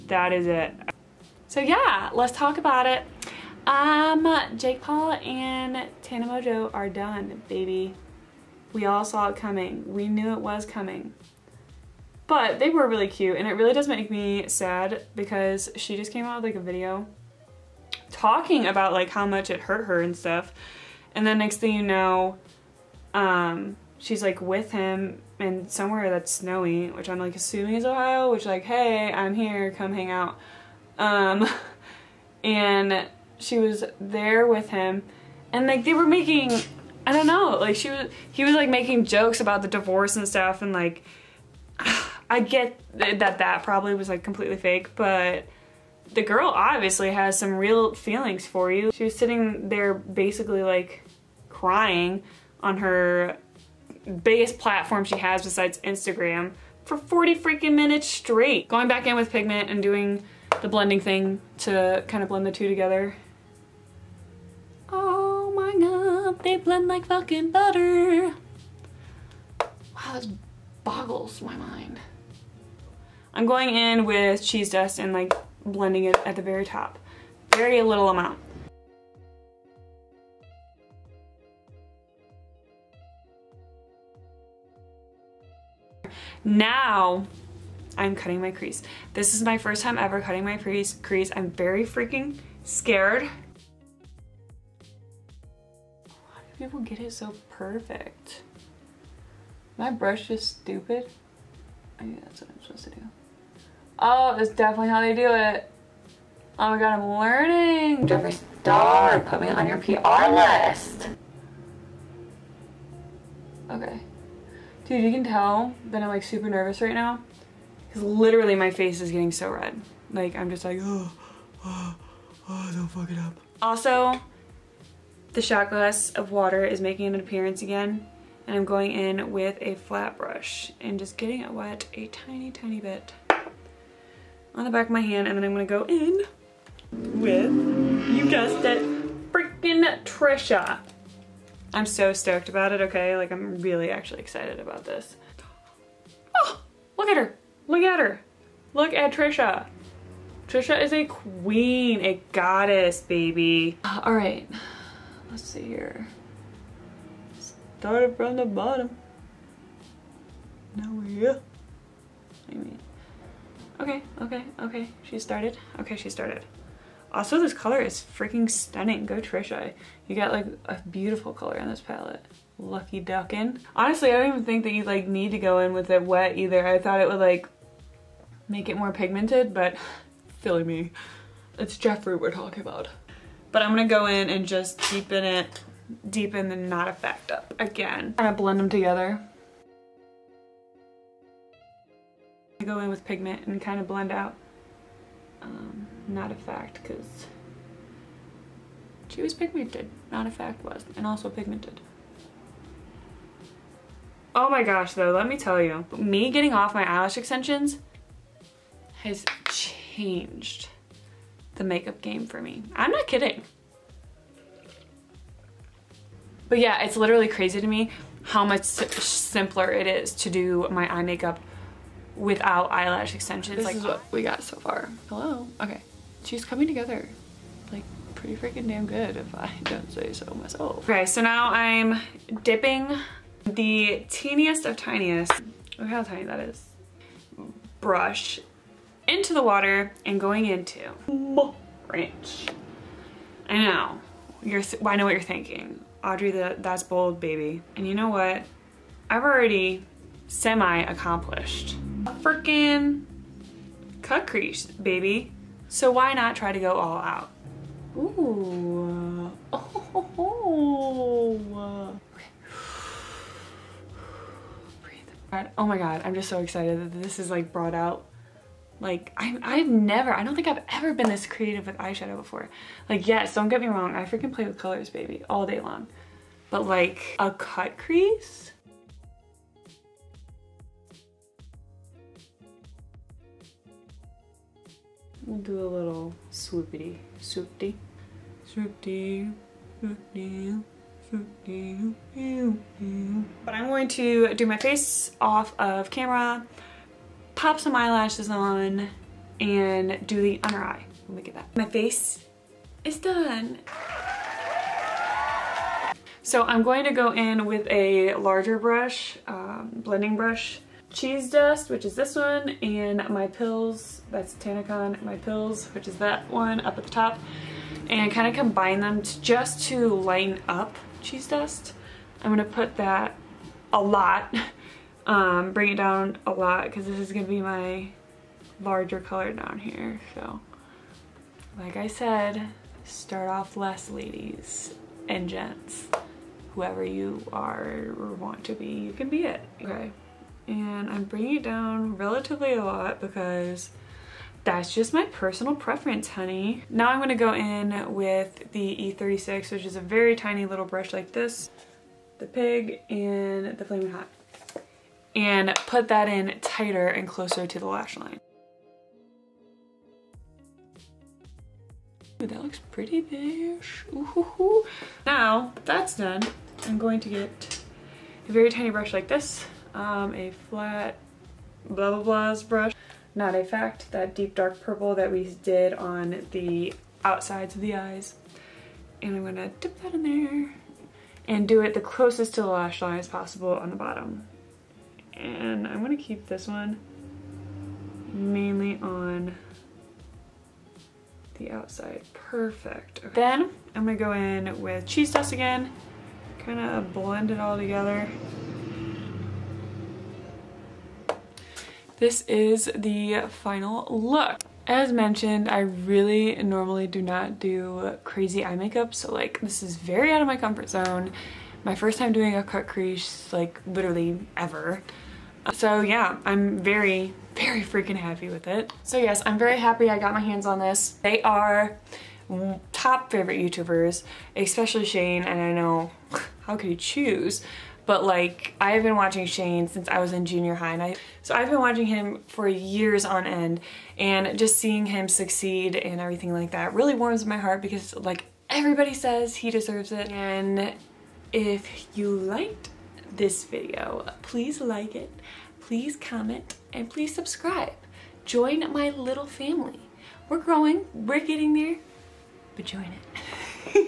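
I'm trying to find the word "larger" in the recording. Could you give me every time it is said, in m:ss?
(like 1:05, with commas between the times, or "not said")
5:08, 5:28.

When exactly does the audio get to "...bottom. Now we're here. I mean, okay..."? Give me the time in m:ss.
2:38.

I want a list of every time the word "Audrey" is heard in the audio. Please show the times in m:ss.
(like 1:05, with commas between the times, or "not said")
4:06.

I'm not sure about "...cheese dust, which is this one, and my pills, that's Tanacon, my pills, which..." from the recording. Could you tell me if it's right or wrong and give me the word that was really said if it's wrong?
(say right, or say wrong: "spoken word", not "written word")
right.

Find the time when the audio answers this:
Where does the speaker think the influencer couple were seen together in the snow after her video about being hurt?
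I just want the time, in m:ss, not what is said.
0:27.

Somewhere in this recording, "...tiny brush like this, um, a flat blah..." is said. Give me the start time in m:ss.
6:08.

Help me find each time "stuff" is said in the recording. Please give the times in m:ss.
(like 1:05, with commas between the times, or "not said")
0:20, 0:40.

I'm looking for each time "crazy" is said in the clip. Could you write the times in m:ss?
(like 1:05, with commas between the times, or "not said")
3:37, 6:48.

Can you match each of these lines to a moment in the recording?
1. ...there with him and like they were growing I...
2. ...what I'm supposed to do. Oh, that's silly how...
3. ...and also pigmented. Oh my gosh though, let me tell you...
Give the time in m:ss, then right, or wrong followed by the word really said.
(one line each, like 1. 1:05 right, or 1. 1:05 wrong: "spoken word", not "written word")
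1. 0:33 wrong: "making", not "growing"
2. 1:42 wrong: "definitely", not "silly"
3. 3:20 right.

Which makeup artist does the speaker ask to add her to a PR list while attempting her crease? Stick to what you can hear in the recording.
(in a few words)
Jeffree Star.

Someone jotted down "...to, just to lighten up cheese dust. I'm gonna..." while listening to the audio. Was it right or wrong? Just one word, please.
right.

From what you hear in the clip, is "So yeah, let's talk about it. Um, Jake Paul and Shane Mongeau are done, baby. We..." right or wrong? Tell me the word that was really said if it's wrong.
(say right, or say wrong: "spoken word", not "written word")
wrong: "Tana", not "Shane".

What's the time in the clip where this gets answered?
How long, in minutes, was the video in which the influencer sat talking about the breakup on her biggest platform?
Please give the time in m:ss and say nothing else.
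0:56.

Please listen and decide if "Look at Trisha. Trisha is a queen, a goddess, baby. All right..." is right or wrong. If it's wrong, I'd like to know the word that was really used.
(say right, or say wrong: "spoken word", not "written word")
right.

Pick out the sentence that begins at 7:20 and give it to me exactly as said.
And if you liked this video.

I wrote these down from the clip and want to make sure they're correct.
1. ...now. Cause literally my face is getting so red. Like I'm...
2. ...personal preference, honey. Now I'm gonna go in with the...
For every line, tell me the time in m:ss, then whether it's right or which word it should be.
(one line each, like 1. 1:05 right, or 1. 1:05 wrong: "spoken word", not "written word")
1. 1:56 right
2. 5:45 right.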